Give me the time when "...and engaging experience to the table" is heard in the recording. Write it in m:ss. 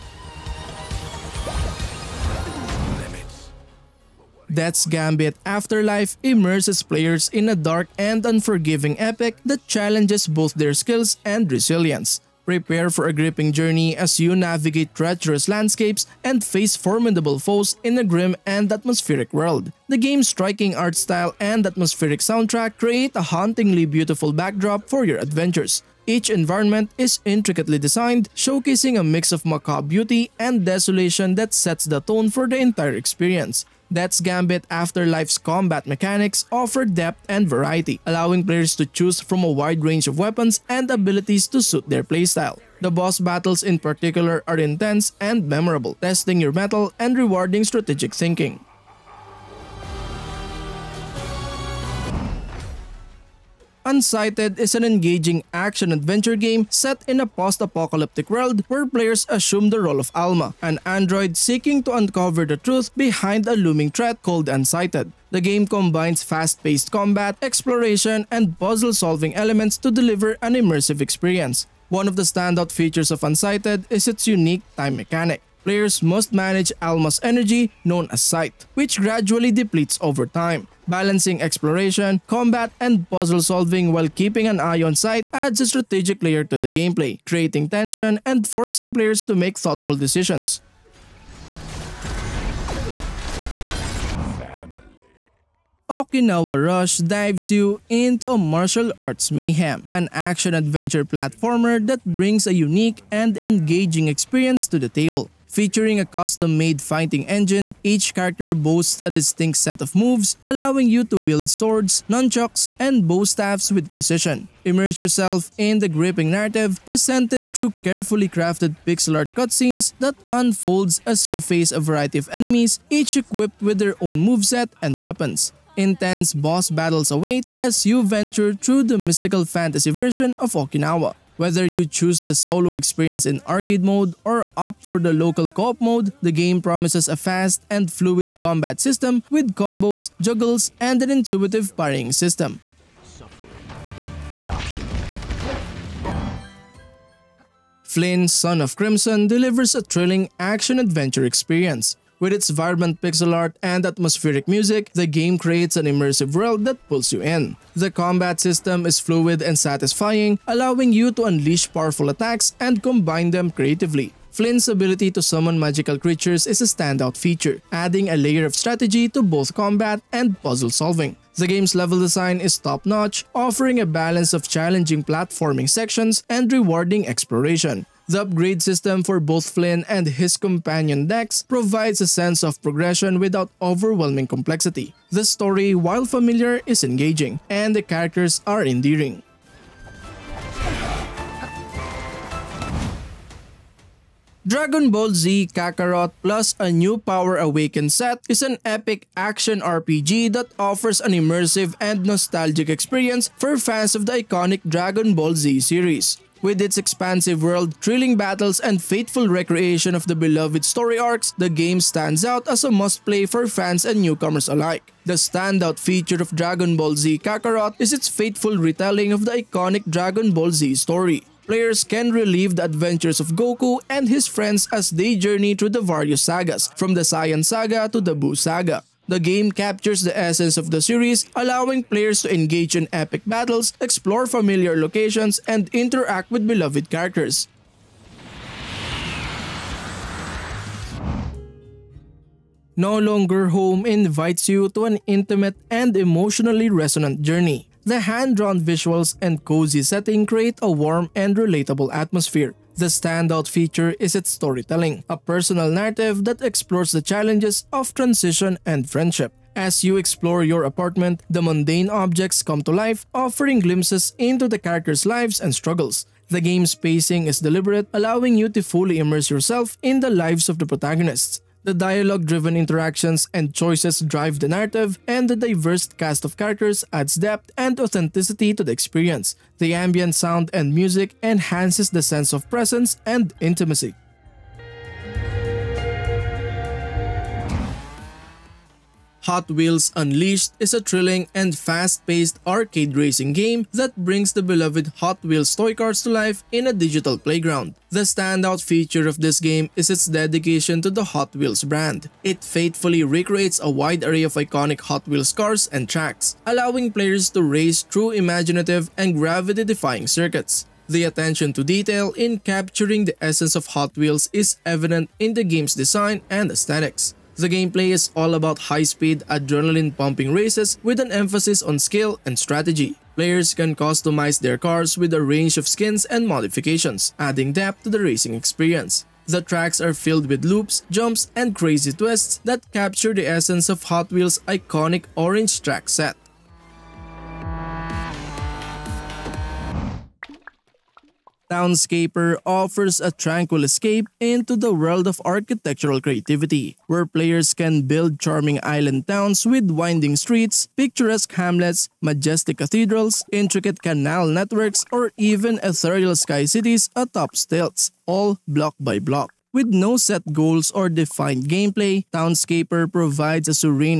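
1:43.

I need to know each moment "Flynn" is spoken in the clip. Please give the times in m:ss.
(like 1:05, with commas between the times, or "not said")
2:27, 2:44, 2:59.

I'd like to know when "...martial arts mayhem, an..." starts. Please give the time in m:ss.
1:38.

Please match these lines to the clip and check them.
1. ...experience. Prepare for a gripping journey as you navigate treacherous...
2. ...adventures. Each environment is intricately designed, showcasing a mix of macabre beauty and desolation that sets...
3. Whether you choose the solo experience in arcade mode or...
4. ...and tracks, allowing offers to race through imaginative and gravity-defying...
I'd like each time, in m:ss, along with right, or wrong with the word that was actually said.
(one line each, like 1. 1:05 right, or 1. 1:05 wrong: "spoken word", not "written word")
1. 0:11 wrong: "resilience", not "experience"
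2. 0:25 right
3. 2:11 right
4. 5:05 wrong: "players", not "offers".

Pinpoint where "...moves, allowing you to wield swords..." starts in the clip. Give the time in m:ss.
1:49.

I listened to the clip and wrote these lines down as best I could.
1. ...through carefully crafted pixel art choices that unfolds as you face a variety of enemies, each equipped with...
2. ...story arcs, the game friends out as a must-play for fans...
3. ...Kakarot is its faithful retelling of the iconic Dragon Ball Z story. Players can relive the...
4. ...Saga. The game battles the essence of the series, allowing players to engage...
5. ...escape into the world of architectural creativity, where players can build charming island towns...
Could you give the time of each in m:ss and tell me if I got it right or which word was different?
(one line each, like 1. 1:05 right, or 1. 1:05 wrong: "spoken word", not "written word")
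1. 1:57 wrong: "cutscenes", not "choices"
2. 3:30 wrong: "stands", not "friends"
3. 3:37 right
4. 3:48 wrong: "captures", not "battles"
5. 5:43 right.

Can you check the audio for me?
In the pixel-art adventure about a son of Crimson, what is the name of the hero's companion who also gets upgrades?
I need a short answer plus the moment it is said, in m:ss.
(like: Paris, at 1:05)
Dex, at 3:01.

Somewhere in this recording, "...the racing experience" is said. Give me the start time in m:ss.
5:27.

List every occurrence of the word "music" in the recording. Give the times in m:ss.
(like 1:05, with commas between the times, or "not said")
2:34, 4:40.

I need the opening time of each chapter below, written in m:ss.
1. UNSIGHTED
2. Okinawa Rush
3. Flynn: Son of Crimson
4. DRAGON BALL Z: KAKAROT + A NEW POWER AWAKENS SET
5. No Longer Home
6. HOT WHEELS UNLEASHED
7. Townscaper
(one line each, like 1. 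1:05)
1. 0:51
2. 1:33
3. 2:25
4. 3:12
5. 4:00
6. 4:47
7. 5:39.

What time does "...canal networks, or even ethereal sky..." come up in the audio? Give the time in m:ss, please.
5:53.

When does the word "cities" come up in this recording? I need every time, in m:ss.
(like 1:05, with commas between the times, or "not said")
5:56.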